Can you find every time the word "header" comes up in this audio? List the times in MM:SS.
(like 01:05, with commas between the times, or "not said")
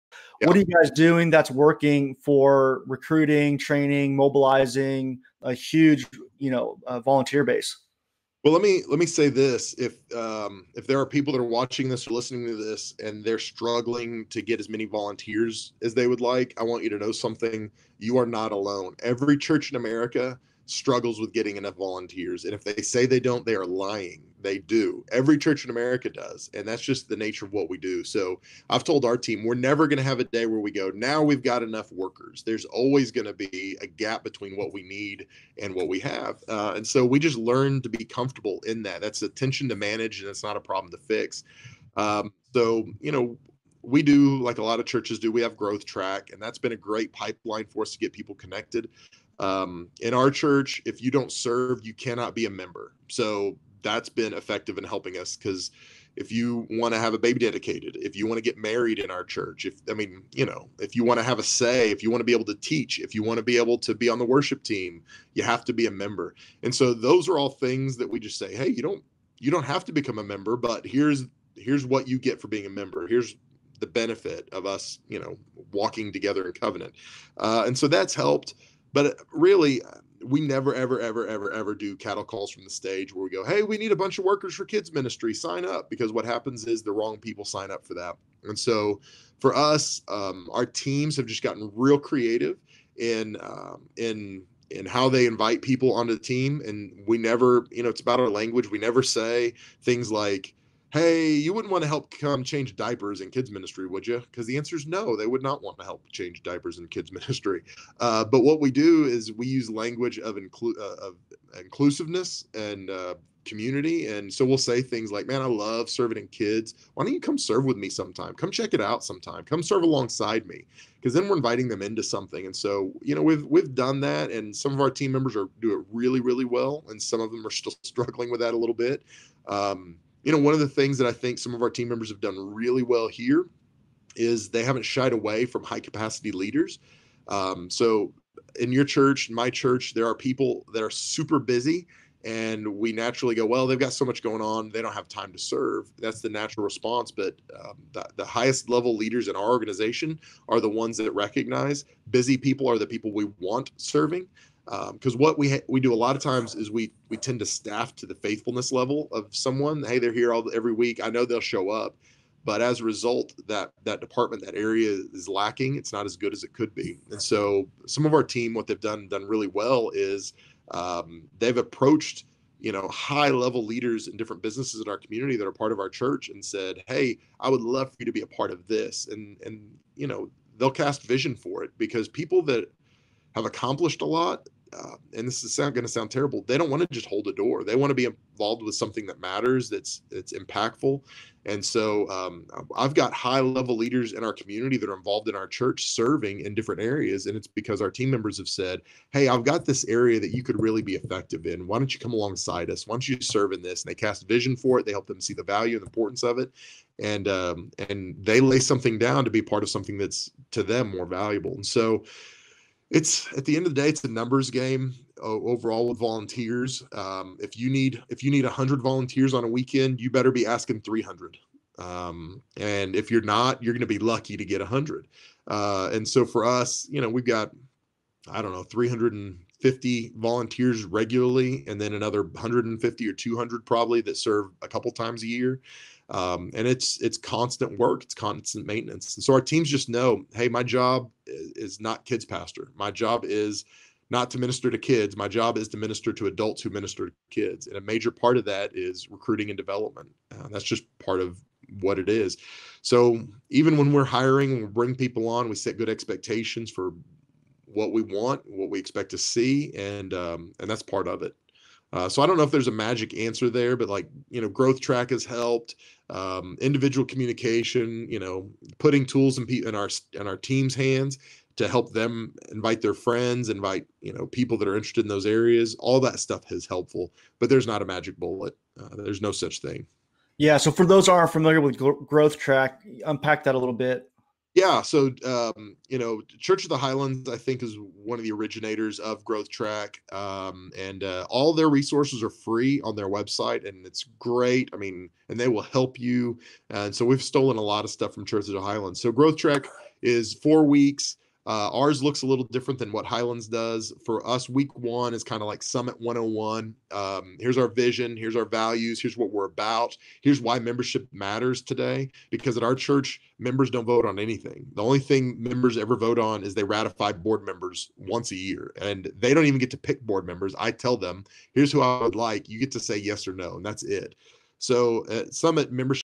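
not said.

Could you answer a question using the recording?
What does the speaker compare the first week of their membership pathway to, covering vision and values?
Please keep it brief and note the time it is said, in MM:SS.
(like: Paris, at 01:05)
Summit 101, at 05:05.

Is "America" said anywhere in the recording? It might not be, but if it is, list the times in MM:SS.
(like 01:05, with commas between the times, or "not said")
00:19, 00:25.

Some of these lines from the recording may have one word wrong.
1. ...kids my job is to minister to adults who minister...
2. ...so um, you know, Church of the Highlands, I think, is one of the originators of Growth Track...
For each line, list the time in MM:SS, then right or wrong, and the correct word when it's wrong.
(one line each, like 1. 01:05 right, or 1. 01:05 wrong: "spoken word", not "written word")
1. 04:04 right
2. 04:44 right.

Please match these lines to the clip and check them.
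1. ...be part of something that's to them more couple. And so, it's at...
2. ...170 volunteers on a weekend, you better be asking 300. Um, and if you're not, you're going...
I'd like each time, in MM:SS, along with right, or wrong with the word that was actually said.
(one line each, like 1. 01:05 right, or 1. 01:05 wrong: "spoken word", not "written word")
1. 03:29 wrong: "valuable", not "couple"
2. 03:38 wrong: "100", not "170".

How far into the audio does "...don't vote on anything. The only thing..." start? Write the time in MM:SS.
05:13.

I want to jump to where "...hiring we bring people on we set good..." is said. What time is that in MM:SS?
04:14.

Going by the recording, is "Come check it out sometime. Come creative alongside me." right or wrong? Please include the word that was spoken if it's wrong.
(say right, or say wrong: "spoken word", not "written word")
wrong: "serve", not "creative".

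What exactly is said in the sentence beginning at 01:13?
Here's the benefit of us, you know, walking together in covenant.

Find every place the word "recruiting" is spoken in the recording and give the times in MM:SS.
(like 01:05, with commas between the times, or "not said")
00:02, 04:09.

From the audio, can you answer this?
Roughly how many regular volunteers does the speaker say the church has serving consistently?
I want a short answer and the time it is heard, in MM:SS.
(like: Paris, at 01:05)
350, at 03:48.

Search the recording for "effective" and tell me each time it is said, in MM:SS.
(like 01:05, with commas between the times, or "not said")
00:54, 03:20.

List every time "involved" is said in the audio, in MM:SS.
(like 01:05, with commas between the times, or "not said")
03:08, 03:14.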